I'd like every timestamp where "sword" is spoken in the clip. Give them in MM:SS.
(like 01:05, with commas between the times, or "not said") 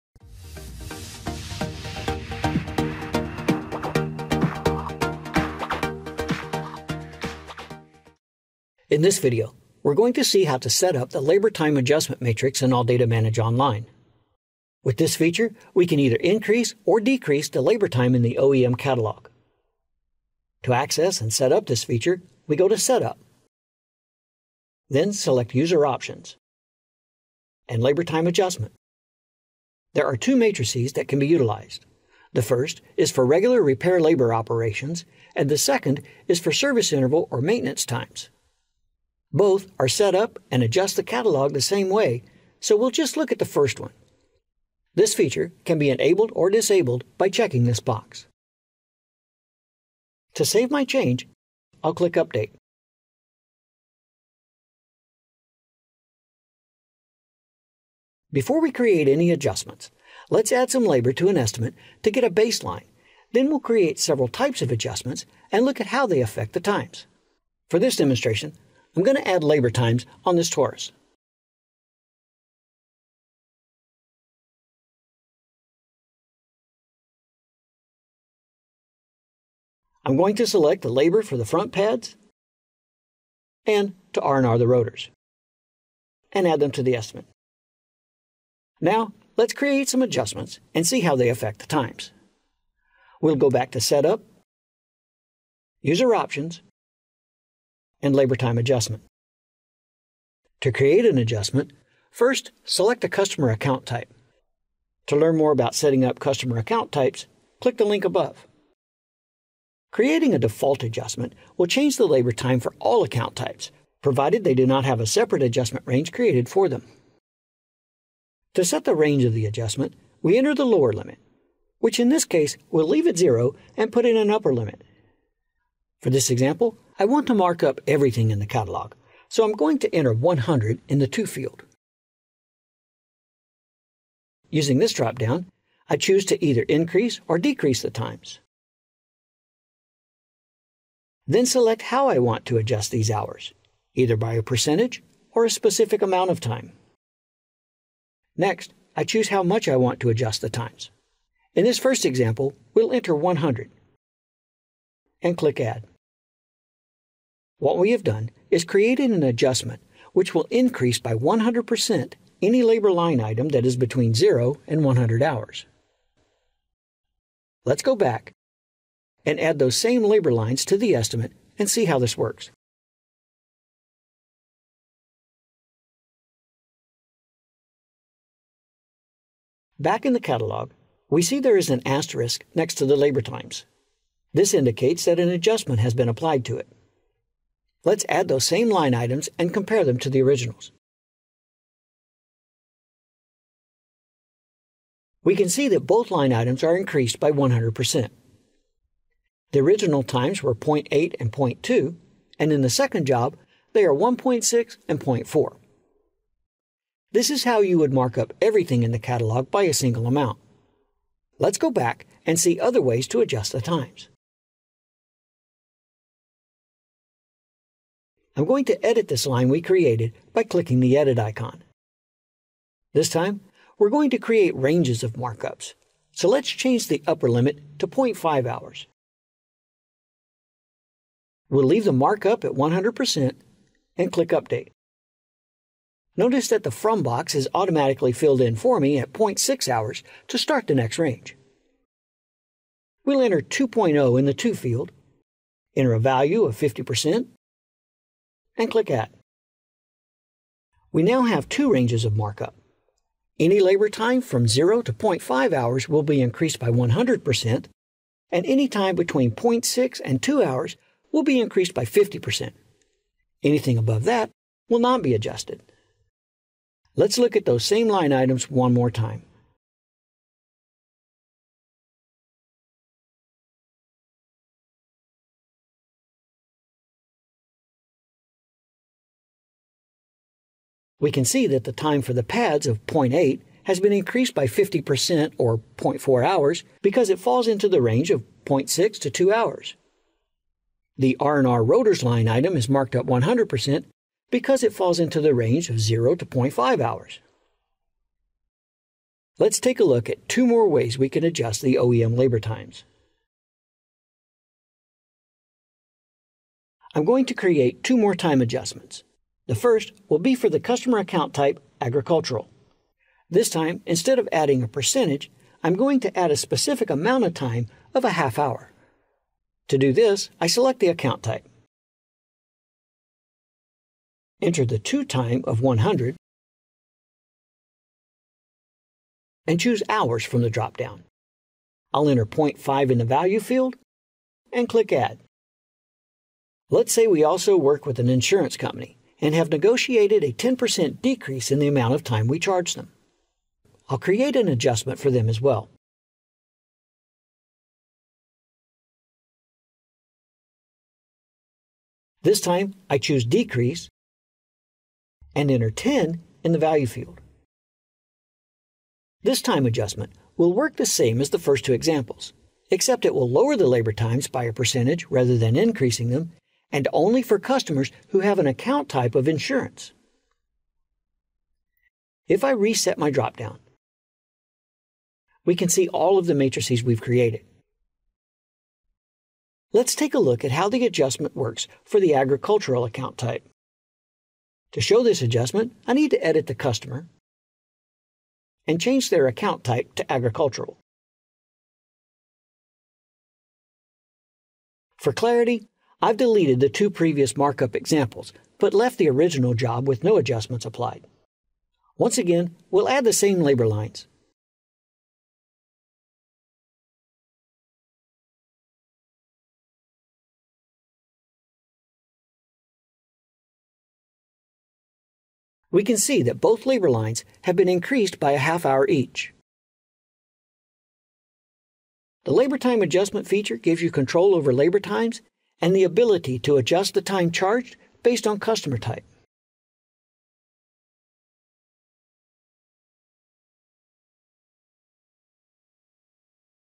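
not said.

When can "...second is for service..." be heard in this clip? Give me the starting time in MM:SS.
00:35.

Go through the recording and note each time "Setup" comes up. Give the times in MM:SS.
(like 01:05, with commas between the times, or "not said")
00:22, 01:33.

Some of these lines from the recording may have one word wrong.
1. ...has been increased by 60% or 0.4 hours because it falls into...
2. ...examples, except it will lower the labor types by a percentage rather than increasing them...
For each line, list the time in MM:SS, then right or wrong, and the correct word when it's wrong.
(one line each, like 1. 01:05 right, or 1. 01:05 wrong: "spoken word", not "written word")
1. 04:43 wrong: "50", not "60"
2. 06:01 wrong: "times", not "types".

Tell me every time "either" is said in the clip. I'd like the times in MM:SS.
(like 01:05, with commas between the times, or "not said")
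00:15, 02:16, 02:23.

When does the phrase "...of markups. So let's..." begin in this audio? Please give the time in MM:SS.
03:45.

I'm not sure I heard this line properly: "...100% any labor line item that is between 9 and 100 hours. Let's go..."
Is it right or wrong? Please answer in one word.
wrong.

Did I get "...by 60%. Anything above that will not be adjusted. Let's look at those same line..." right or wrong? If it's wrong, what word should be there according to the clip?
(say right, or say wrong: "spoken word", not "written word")
wrong: "50", not "60".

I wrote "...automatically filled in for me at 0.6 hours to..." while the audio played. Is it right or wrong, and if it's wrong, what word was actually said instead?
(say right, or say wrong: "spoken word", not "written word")
right.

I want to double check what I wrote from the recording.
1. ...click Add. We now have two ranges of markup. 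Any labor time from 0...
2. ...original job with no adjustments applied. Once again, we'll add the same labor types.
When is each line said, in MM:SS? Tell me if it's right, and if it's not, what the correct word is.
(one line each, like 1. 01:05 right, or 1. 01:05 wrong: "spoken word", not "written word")
1. 04:08 right
2. 06:39 wrong: "lines", not "types".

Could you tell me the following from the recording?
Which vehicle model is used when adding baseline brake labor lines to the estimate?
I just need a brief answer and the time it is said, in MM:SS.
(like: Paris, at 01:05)
Taurus, at 01:10.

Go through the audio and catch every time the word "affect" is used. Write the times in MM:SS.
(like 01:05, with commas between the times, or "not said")
01:06, 01:31.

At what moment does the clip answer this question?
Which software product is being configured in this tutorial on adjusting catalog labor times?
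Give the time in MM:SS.
00:12.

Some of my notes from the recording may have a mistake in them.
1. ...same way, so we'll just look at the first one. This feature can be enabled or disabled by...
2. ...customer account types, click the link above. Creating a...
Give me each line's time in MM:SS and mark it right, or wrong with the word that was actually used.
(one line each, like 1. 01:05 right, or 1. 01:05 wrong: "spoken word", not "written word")
1. 00:41 right
2. 01:46 right.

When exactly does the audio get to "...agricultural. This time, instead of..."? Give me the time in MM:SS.
05:11.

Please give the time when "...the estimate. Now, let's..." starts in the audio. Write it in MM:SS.
01:26.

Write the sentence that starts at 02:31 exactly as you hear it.
In this first example, we'll enter 100 and click Add.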